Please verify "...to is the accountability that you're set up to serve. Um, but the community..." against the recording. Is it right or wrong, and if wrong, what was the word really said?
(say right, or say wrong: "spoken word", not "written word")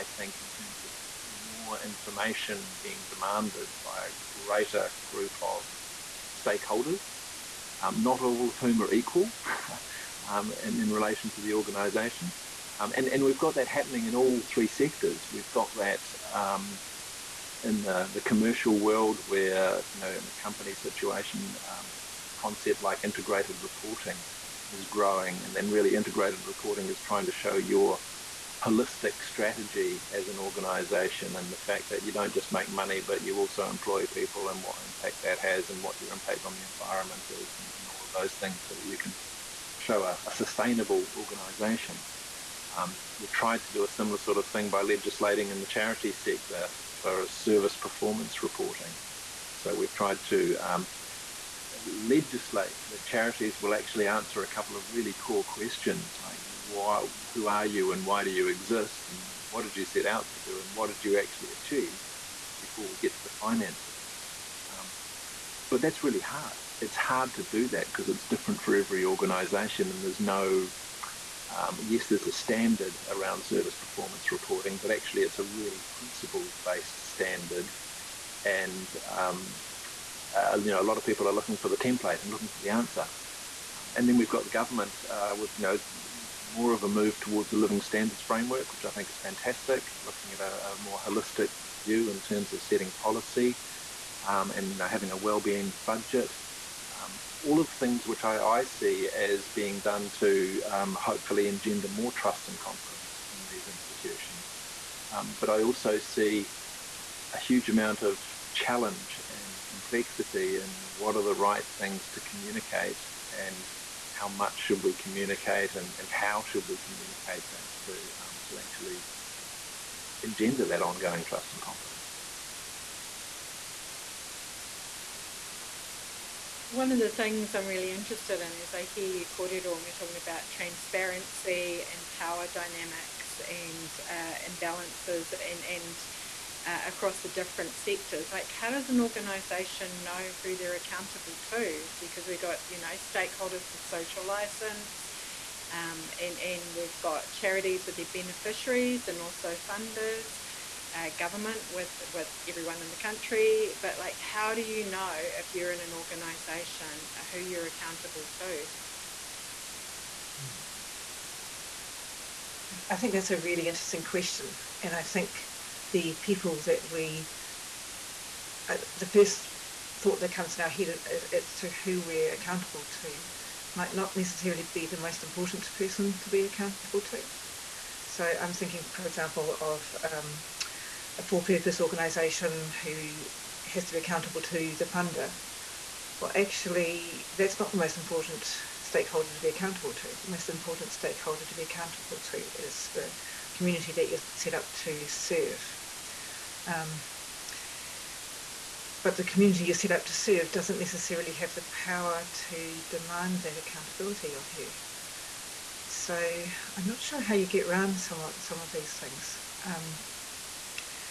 wrong: "community", not "accountability".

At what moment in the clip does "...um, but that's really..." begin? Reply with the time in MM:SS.
01:04.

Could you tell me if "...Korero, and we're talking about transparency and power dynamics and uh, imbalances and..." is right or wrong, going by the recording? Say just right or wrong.
right.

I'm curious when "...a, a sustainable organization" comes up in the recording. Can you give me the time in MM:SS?
00:40.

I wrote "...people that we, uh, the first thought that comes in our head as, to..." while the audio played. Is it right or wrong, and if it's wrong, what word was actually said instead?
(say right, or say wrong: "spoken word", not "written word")
right.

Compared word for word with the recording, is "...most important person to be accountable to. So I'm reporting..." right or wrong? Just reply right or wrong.
wrong.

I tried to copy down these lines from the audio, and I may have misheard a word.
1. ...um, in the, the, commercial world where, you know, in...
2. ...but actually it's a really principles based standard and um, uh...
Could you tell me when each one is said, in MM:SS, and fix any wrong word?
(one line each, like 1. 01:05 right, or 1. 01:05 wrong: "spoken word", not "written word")
1. 00:16 right
2. 01:14 right.